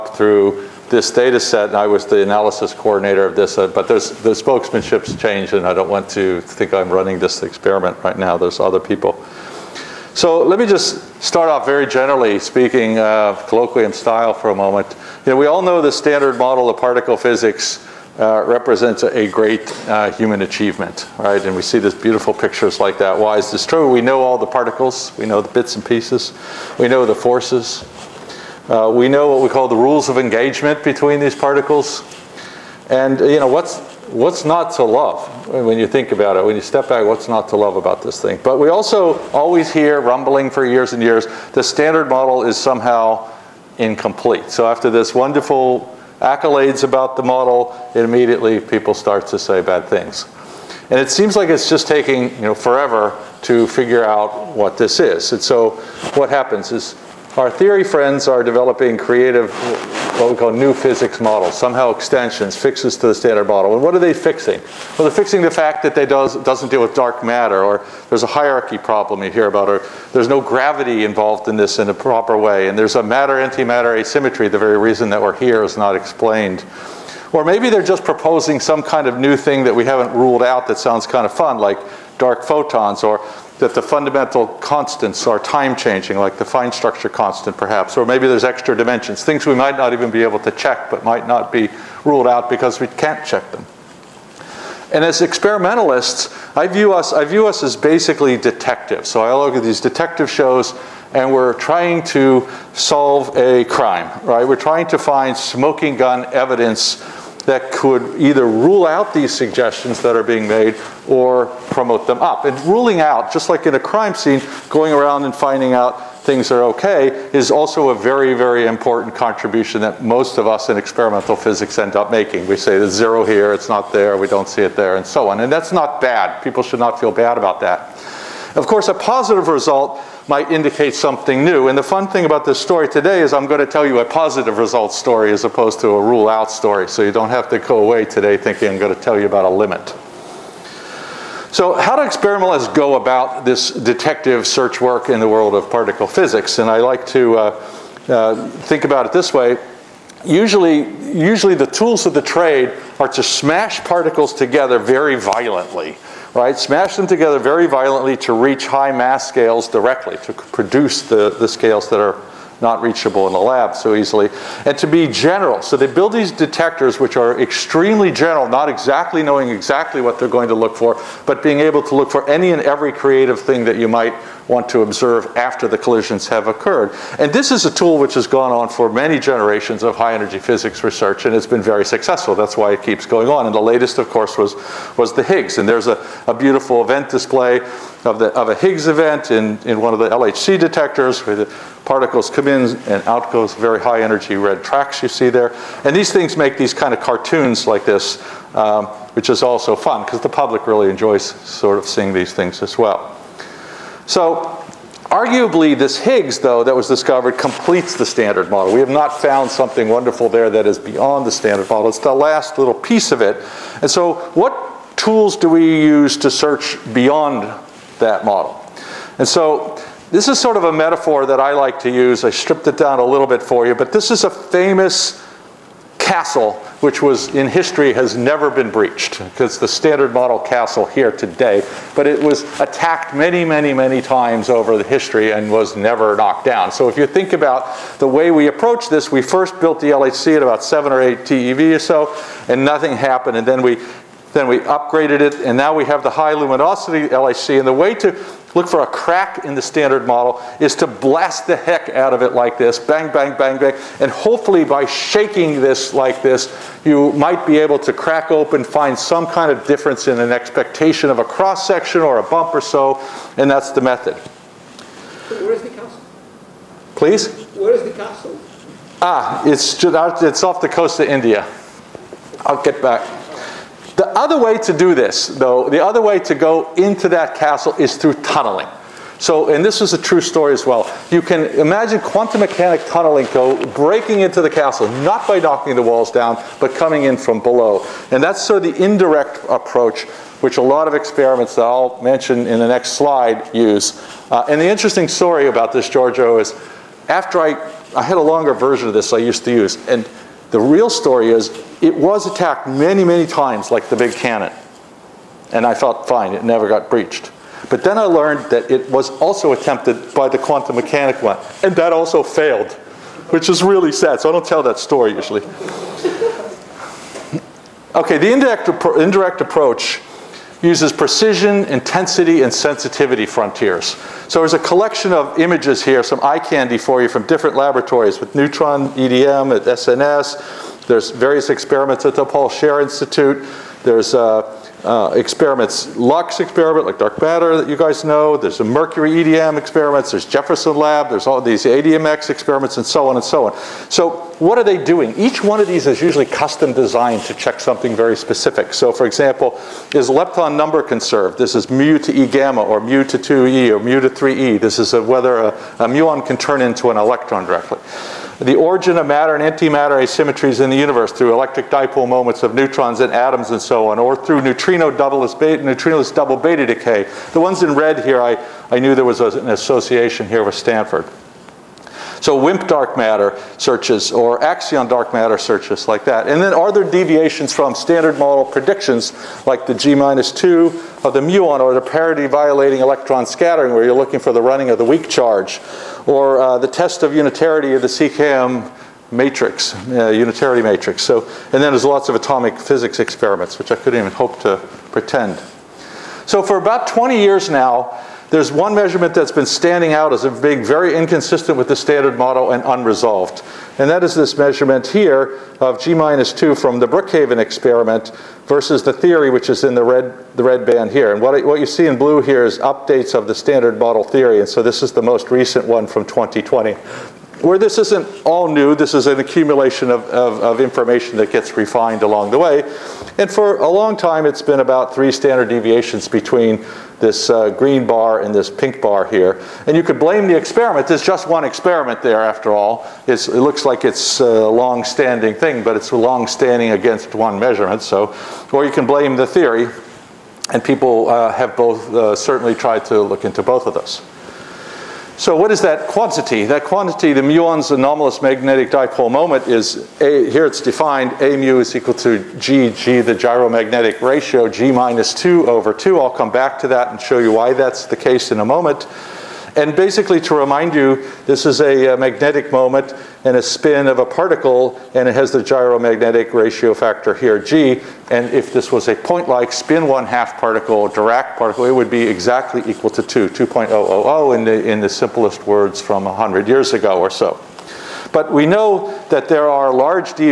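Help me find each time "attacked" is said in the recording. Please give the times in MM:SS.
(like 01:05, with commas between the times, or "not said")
03:52, 05:02.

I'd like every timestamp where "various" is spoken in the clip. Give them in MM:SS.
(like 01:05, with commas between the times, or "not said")
05:31.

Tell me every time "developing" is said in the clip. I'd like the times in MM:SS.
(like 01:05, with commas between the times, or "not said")
00:58.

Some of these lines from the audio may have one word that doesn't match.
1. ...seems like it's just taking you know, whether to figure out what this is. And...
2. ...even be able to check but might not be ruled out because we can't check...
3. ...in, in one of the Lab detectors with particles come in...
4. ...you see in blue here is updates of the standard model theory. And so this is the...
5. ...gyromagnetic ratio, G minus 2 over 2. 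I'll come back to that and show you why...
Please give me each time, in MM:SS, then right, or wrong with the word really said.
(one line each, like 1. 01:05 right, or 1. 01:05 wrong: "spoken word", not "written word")
1. 00:51 wrong: "forever", not "whether"
2. 01:29 right
3. 03:09 wrong: "LHC", not "Lab"
4. 06:51 right
5. 07:33 right.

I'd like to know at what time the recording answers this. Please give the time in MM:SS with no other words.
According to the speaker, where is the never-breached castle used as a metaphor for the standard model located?
04:30.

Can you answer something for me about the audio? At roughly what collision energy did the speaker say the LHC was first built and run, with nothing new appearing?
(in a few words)
7 or 8 TeV.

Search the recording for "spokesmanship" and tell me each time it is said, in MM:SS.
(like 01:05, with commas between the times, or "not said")
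00:04.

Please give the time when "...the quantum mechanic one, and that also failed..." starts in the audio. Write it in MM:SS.
05:10.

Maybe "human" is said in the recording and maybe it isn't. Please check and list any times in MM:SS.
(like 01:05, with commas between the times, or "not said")
00:20.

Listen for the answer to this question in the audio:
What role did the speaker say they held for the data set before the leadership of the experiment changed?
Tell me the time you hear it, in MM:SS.
00:02.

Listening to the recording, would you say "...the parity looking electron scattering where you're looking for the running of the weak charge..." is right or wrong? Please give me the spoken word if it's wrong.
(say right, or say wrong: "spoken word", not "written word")
wrong: "violating", not "looking".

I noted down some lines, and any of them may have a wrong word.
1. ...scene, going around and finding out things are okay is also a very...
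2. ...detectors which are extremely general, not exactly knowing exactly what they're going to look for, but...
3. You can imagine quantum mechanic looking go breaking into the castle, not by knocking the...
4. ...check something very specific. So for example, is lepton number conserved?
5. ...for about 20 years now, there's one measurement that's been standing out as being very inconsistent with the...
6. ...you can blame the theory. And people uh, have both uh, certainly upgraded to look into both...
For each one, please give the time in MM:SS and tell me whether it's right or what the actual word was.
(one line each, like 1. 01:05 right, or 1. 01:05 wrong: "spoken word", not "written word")
1. 01:54 right
2. 02:46 right
3. 04:41 wrong: "tunneling", not "looking"
4. 05:47 right
5. 06:36 right
6. 07:18 wrong: "tried", not "upgraded".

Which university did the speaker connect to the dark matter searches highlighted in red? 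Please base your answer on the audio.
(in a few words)
Stanford.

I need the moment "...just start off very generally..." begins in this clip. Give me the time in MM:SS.
00:10.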